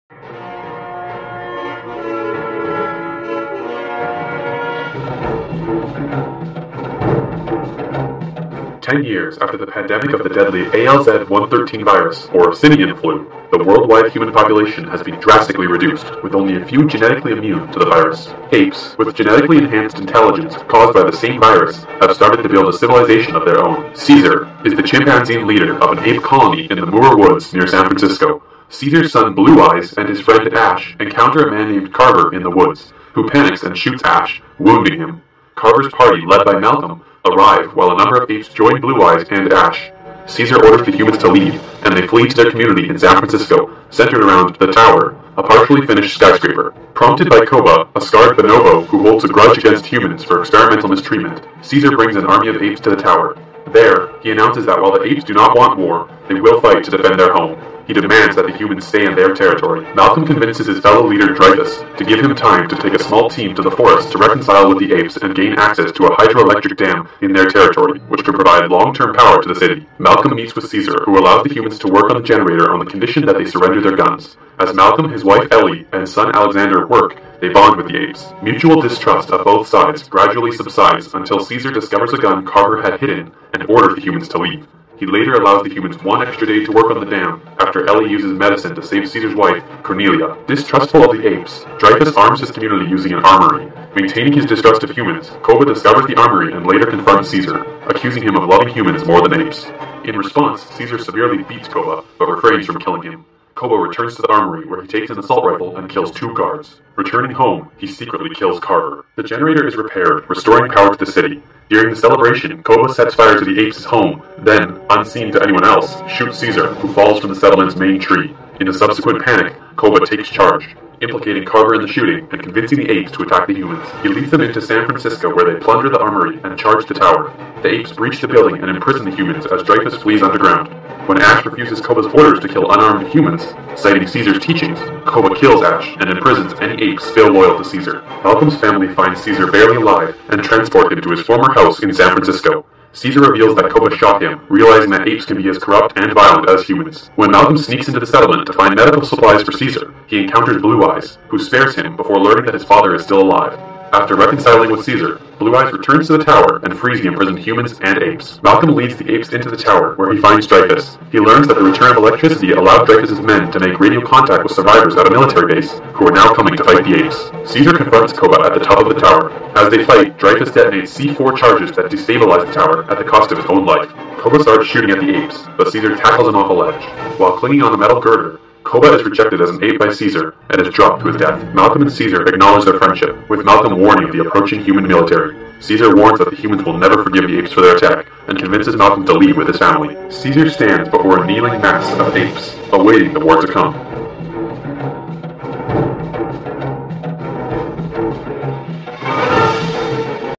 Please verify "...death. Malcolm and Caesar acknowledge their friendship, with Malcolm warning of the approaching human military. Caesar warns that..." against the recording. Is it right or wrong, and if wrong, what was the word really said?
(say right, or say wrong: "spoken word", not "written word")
right.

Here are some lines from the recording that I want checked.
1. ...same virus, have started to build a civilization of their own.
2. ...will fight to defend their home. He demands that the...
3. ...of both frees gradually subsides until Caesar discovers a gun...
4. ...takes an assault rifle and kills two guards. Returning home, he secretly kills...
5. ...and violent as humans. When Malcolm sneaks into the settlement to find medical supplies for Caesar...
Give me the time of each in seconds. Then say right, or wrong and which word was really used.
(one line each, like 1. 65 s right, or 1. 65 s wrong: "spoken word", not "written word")
1. 21 s right
2. 56 s right
3. 79 s wrong: "sides", not "frees"
4. 104 s right
5. 145 s right.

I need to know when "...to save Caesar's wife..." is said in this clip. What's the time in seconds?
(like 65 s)
88 s.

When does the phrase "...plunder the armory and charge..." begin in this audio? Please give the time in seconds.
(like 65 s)
125 s.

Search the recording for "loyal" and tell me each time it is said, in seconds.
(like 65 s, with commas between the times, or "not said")
137 s.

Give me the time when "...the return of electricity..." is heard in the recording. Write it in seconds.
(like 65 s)
161 s.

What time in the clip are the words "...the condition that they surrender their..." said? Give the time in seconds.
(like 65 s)
72 s.